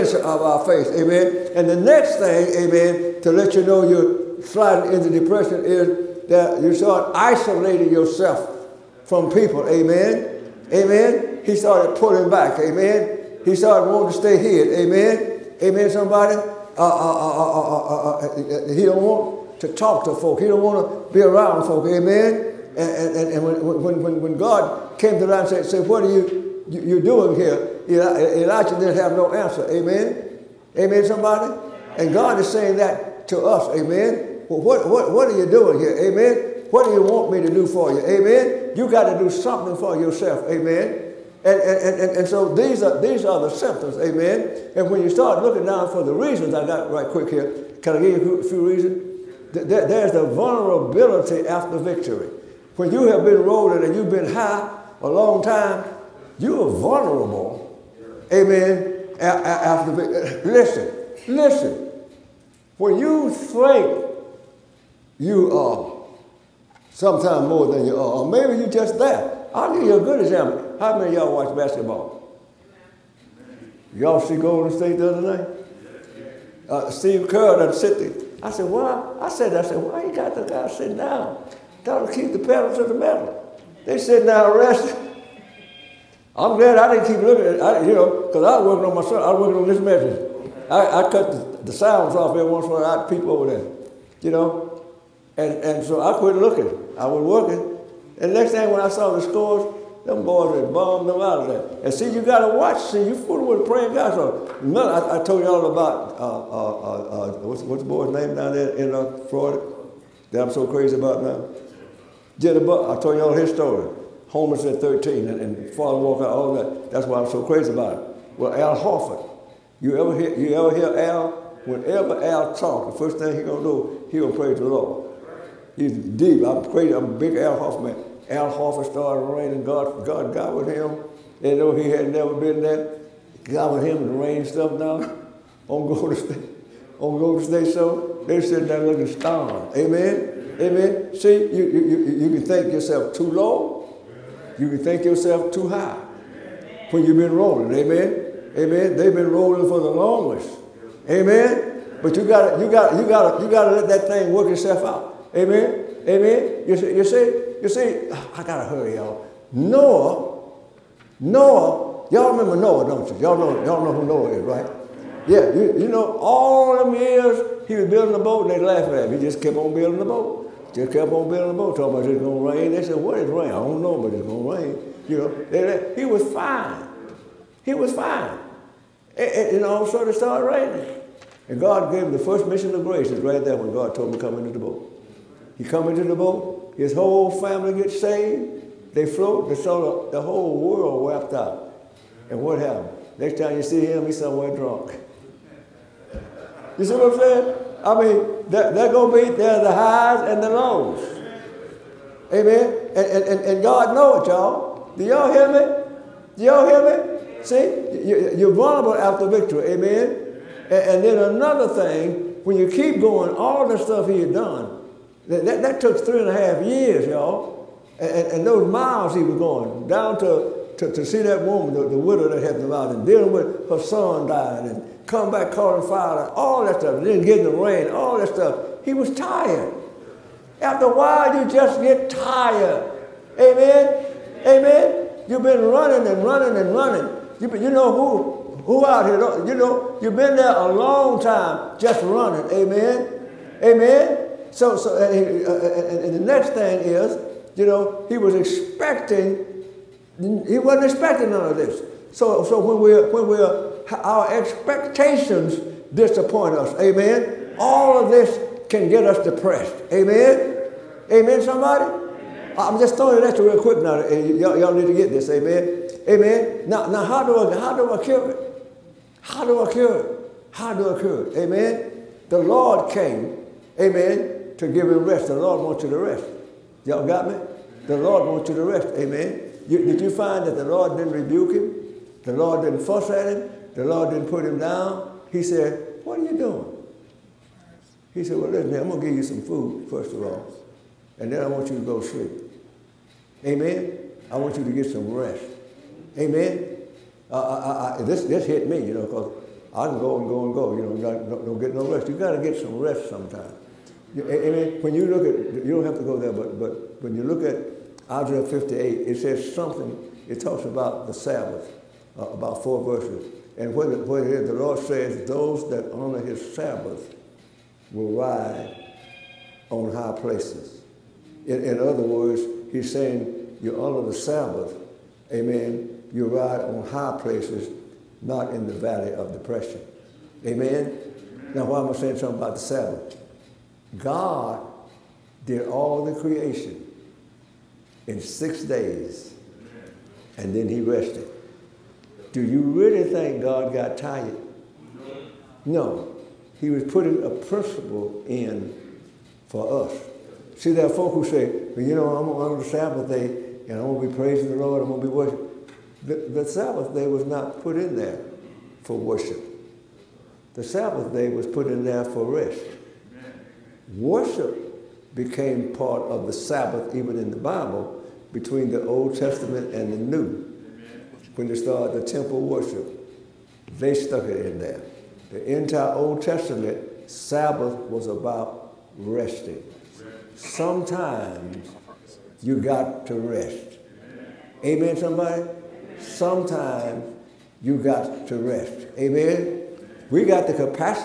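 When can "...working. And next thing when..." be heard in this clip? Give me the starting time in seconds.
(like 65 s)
97 s.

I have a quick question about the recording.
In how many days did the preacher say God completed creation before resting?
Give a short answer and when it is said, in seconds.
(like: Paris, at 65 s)
6, at 338 s.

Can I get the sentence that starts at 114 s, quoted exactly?
Homer said 13 and, and Father Walker, all that.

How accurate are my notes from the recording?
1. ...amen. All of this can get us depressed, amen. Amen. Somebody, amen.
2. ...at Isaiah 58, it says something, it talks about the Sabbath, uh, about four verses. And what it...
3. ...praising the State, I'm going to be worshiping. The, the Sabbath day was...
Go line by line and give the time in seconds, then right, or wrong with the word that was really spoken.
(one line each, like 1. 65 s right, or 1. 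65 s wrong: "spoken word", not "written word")
1. 256 s right
2. 307 s right
3. 354 s wrong: "Lord", not "State".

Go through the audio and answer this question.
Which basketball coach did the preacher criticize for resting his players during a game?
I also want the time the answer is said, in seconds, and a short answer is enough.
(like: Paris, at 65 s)
Steve Kerr, at 76 s.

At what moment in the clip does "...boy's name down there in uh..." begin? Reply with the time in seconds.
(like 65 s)
107 s.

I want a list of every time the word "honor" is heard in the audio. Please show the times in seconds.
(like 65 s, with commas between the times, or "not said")
315 s, 323 s.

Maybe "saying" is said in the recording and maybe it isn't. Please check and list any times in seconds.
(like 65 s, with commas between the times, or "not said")
32 s, 197 s, 322 s, 331 s.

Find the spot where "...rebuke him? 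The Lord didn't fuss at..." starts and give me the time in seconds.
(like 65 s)
281 s.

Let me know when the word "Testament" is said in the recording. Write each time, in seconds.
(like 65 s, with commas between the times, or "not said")
369 s, 376 s.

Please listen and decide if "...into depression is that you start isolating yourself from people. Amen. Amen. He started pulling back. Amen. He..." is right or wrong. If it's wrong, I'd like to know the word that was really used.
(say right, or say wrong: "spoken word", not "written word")
right.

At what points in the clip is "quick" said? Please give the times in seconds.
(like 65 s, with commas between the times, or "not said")
47 s, 263 s.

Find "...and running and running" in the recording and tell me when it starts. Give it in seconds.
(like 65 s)
236 s.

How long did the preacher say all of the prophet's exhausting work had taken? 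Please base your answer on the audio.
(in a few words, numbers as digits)
3 and a half years.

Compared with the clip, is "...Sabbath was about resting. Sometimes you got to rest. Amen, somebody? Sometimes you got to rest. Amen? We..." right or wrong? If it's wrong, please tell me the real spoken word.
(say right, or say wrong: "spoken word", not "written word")
right.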